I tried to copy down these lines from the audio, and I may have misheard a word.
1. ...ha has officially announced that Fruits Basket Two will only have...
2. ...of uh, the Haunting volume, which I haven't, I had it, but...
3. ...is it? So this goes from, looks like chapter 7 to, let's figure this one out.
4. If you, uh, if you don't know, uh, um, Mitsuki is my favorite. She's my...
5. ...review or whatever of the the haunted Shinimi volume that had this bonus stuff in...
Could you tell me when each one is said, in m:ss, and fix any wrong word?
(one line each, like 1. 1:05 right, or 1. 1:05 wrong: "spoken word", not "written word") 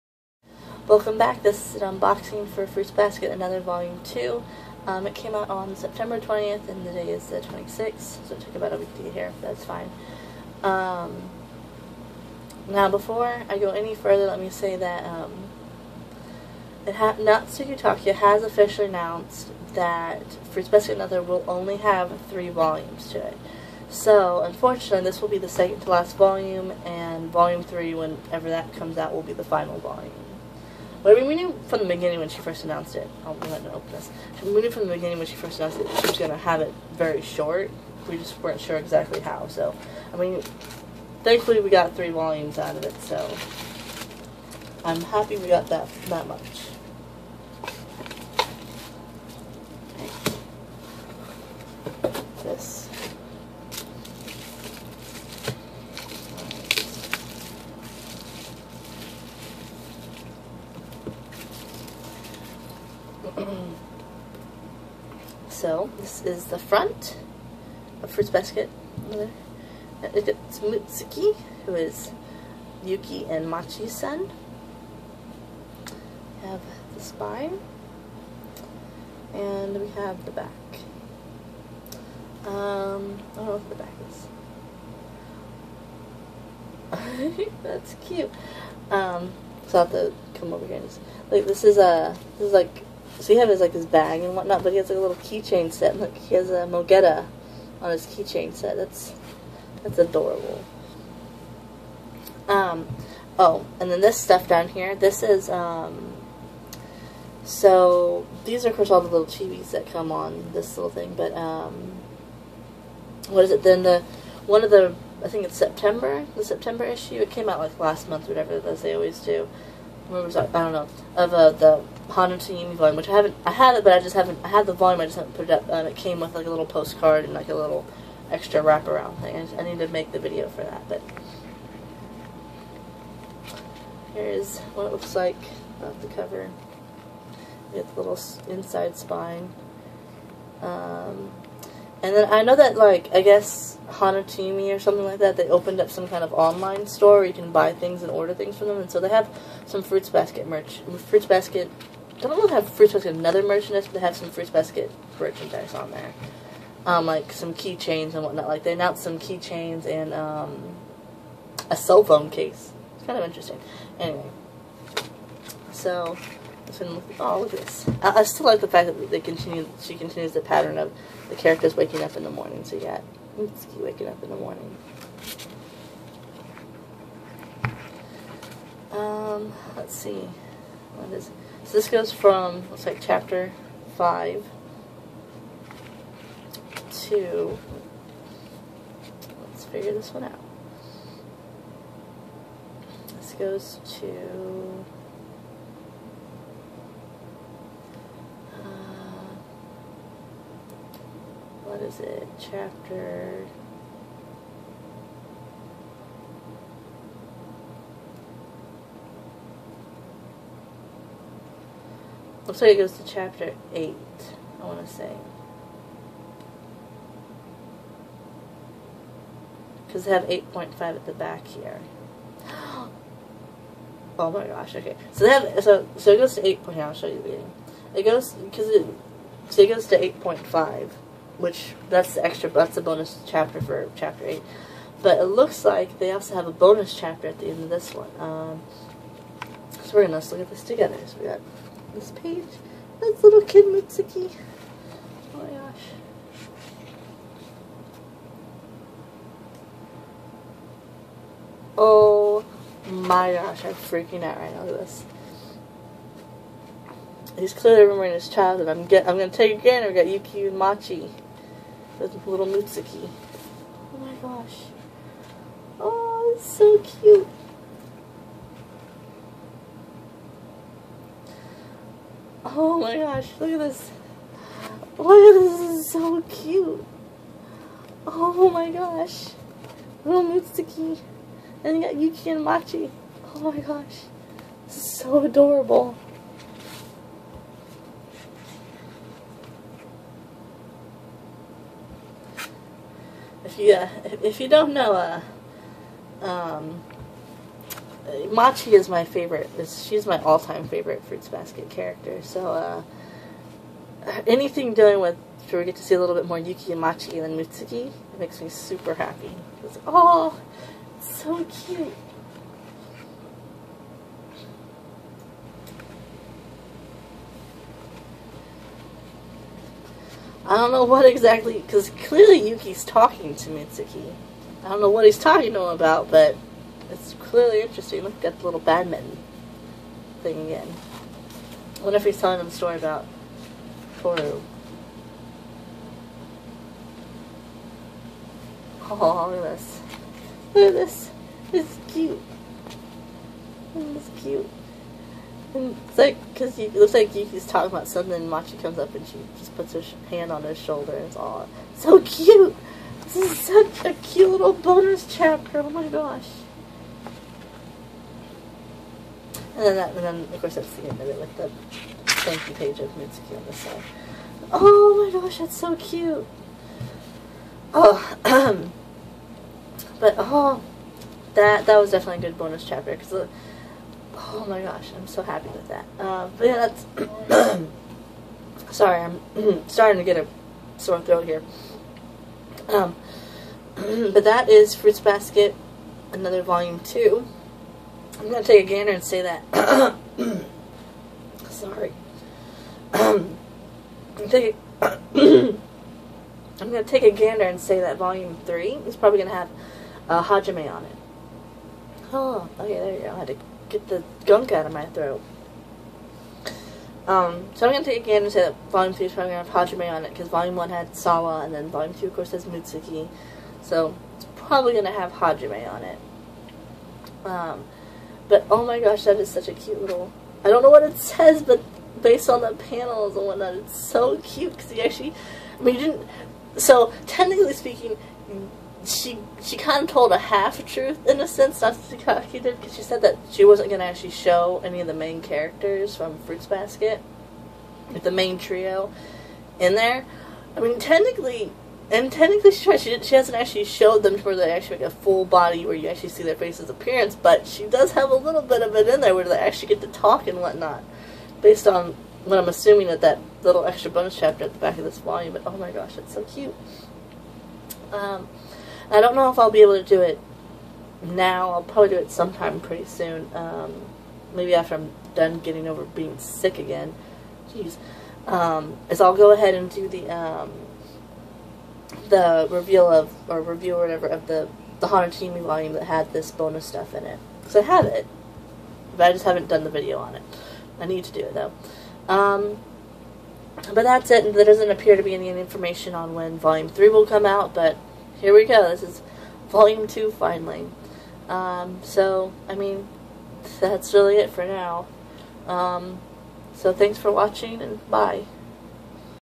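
1. 0:16 wrong: "Another", not "Two"
2. 2:01 right
3. 3:01 wrong: "5", not "7"
4. 4:53 wrong: "Machi", not "Mitsuki"
5. 7:53 right.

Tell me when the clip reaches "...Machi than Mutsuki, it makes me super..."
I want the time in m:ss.
5:06.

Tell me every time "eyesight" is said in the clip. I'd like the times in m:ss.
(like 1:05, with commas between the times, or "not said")
not said.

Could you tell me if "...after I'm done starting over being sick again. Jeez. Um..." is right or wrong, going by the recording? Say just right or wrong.
wrong.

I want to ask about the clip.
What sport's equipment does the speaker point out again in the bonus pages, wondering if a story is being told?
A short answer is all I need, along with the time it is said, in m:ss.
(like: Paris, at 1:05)
badminton, at 5:28.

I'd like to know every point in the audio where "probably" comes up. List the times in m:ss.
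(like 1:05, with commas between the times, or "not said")
6:38, 6:49, 6:54, 7:41.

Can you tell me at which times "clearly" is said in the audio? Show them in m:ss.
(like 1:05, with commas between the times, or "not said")
4:17, 5:22, 5:27.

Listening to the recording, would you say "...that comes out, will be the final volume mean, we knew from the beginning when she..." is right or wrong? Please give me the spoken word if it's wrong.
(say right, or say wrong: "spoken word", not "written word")
right.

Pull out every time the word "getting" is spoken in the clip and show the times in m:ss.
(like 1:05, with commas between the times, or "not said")
7:45.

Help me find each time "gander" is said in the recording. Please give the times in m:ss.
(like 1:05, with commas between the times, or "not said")
6:28, 6:37, 6:48.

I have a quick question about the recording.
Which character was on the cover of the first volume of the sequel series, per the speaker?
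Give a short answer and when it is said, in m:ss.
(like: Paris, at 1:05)
Sawa, at 6:50.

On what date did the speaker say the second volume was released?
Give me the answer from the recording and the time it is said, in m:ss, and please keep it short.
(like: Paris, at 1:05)
September 20th, at 0:05.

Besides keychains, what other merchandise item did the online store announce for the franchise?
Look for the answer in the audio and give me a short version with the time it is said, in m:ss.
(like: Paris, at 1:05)
cell phone case, at 2:41.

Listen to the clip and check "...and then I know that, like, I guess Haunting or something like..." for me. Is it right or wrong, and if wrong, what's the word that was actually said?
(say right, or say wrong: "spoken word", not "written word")
wrong: "Hanatimi", not "Haunting".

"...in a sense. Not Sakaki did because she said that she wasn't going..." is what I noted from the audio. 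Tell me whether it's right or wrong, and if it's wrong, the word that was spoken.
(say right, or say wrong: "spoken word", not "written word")
right.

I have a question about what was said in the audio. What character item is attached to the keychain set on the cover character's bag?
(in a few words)
Mogeta.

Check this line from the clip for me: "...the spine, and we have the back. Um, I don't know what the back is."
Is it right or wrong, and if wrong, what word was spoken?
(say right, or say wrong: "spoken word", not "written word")
right.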